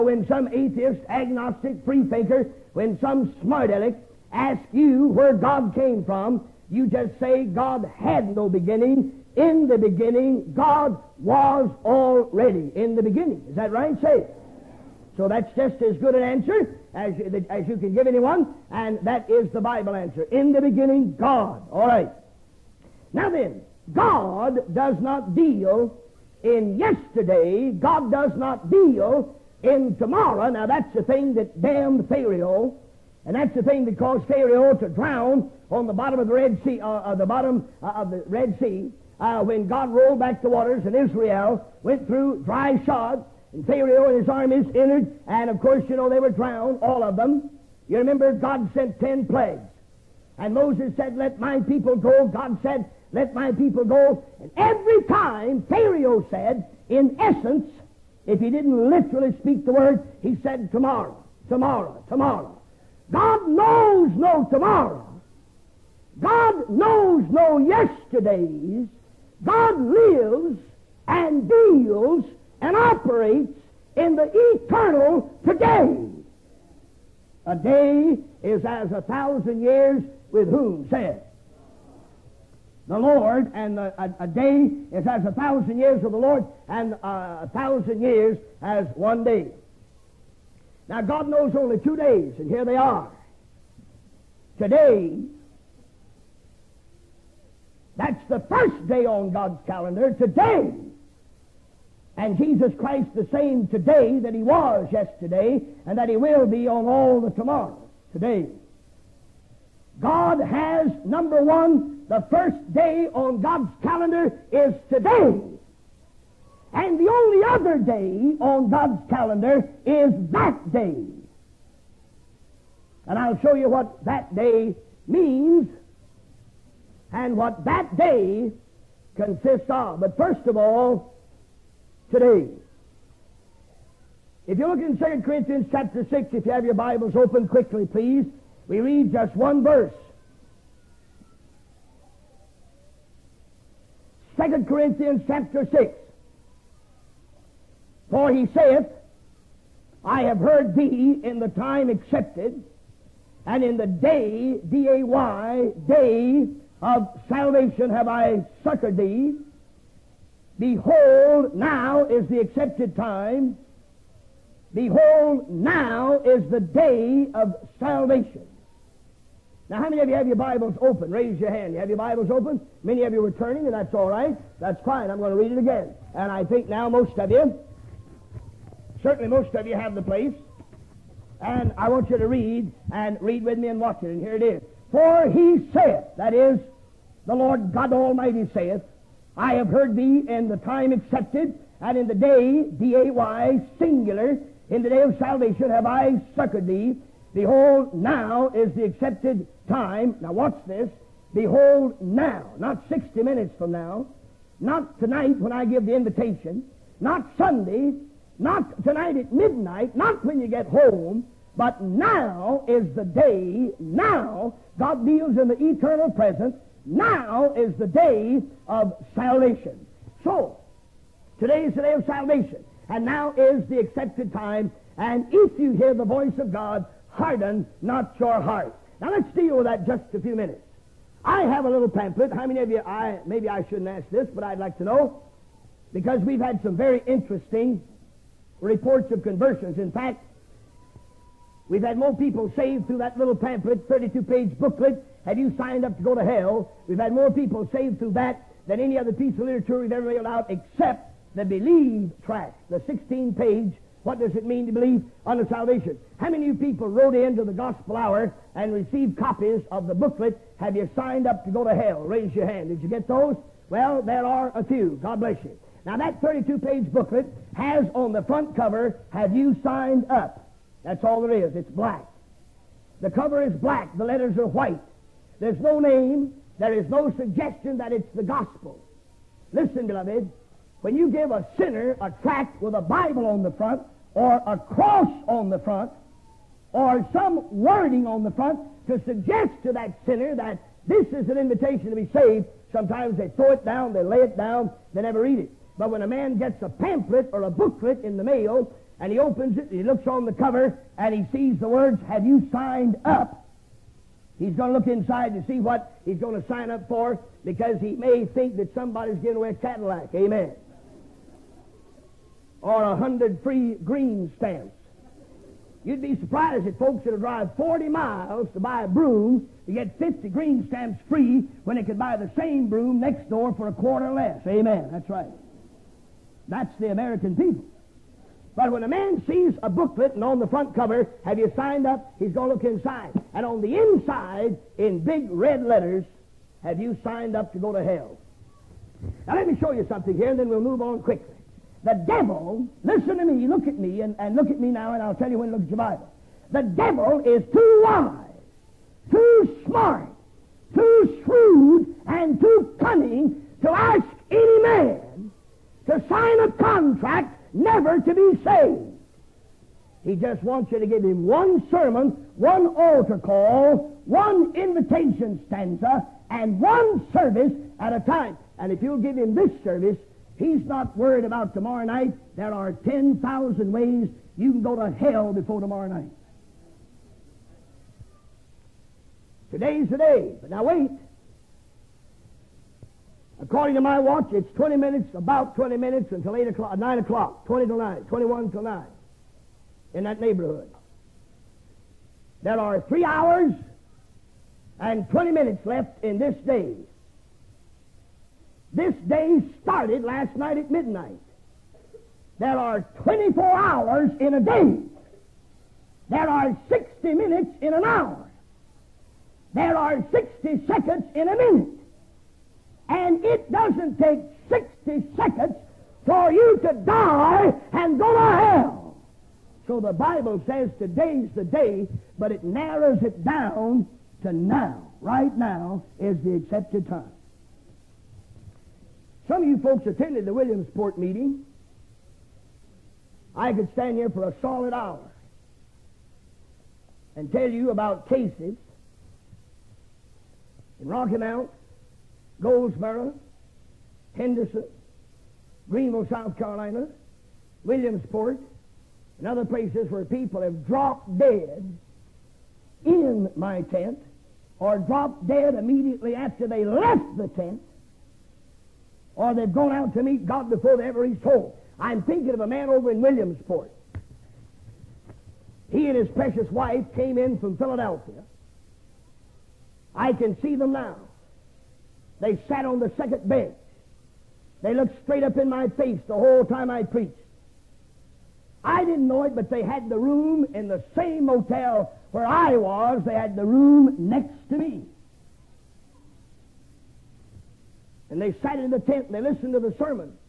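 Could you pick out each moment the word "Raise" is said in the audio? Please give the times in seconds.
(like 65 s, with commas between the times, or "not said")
171 s, 262 s.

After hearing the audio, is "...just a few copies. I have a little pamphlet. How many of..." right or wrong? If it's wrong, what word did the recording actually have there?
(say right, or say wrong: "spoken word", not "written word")
wrong: "minutes", not "copies".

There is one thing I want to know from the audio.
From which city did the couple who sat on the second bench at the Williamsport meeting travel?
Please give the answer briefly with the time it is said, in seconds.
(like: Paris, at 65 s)
Philadelphia, at 467 s.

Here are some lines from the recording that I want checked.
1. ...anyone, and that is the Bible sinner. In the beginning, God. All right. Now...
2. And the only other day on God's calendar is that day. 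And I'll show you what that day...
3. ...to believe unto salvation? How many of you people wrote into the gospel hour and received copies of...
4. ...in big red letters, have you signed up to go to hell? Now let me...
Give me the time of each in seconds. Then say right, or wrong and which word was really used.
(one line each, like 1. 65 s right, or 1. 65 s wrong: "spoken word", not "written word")
1. 18 s wrong: "answer", not "sinner"
2. 116 s right
3. 254 s right
4. 334 s right.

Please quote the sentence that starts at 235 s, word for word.
Because we've had some very interesting reports of conversions.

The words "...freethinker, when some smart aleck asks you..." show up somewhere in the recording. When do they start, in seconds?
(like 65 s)
1 s.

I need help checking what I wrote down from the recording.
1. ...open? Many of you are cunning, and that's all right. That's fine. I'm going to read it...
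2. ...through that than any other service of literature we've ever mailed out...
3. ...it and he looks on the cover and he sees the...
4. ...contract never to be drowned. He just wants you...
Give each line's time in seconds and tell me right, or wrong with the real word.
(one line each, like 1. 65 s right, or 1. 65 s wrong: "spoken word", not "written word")
1. 172 s wrong: "turning", not "cunning"
2. 247 s wrong: "piece", not "service"
3. 299 s right
4. 356 s wrong: "saved", not "drowned".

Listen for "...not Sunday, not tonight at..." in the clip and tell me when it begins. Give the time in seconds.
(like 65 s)
207 s.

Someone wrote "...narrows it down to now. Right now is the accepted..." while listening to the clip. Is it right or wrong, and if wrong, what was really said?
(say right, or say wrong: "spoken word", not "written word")
right.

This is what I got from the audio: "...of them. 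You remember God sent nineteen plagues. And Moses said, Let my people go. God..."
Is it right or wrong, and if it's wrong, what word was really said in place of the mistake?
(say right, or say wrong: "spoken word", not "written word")
wrong: "ten", not "nineteen".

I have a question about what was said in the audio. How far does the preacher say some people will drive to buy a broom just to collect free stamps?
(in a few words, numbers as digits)
40 miles.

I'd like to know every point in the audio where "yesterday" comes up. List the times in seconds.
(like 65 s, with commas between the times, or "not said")
26 s, 67 s, 104 s.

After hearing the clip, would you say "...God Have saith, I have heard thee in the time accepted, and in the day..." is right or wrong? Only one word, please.
wrong.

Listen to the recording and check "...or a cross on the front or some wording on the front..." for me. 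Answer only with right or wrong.
right.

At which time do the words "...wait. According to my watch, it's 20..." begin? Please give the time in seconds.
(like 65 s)
380 s.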